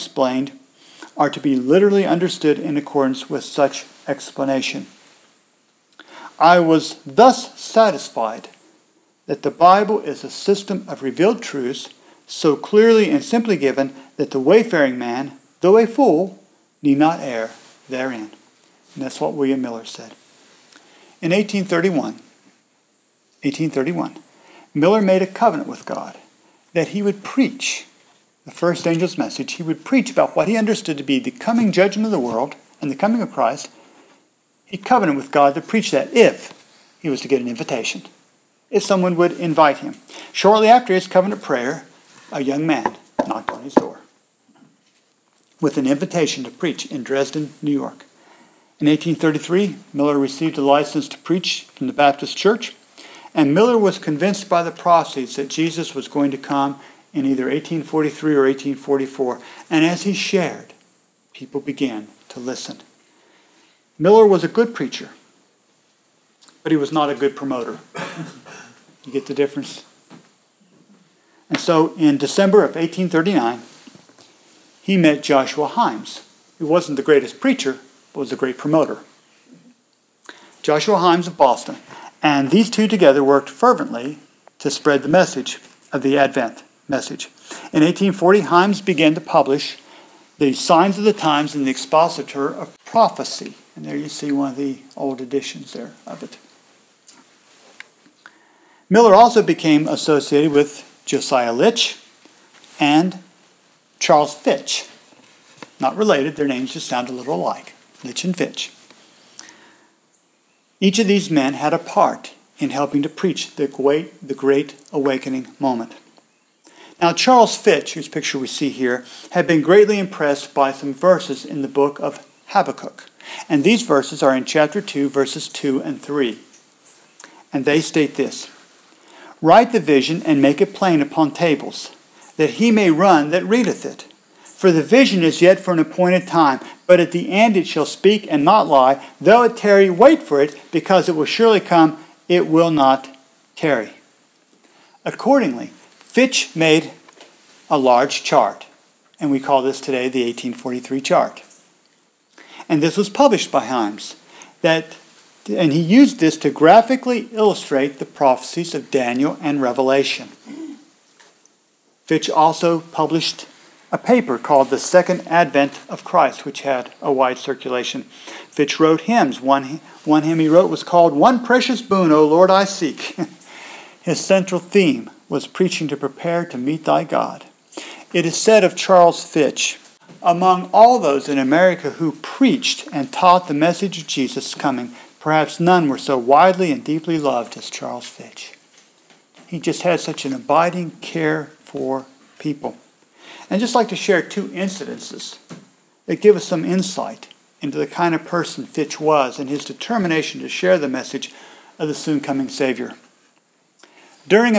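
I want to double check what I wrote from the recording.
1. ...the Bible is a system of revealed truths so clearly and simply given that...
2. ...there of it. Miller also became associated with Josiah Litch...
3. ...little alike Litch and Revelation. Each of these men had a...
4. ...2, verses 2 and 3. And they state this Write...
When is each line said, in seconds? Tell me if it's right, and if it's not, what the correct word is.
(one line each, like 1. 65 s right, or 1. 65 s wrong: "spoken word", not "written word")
1. 9 s right
2. 95 s right
3. 107 s wrong: "Fitch", not "Revelation"
4. 124 s right.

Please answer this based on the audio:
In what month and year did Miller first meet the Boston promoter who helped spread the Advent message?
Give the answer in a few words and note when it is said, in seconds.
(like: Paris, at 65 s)
December 1839, at 72 s.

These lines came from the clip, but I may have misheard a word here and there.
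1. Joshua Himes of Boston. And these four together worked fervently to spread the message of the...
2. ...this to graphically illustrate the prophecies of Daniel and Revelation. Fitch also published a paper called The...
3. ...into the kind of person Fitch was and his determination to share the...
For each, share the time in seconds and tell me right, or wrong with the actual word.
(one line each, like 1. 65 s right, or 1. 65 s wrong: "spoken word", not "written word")
1. 80 s wrong: "two", not "four"
2. 156 s right
3. 197 s right.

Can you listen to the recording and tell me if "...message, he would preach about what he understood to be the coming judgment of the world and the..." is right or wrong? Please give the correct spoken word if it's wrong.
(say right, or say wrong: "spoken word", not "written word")
right.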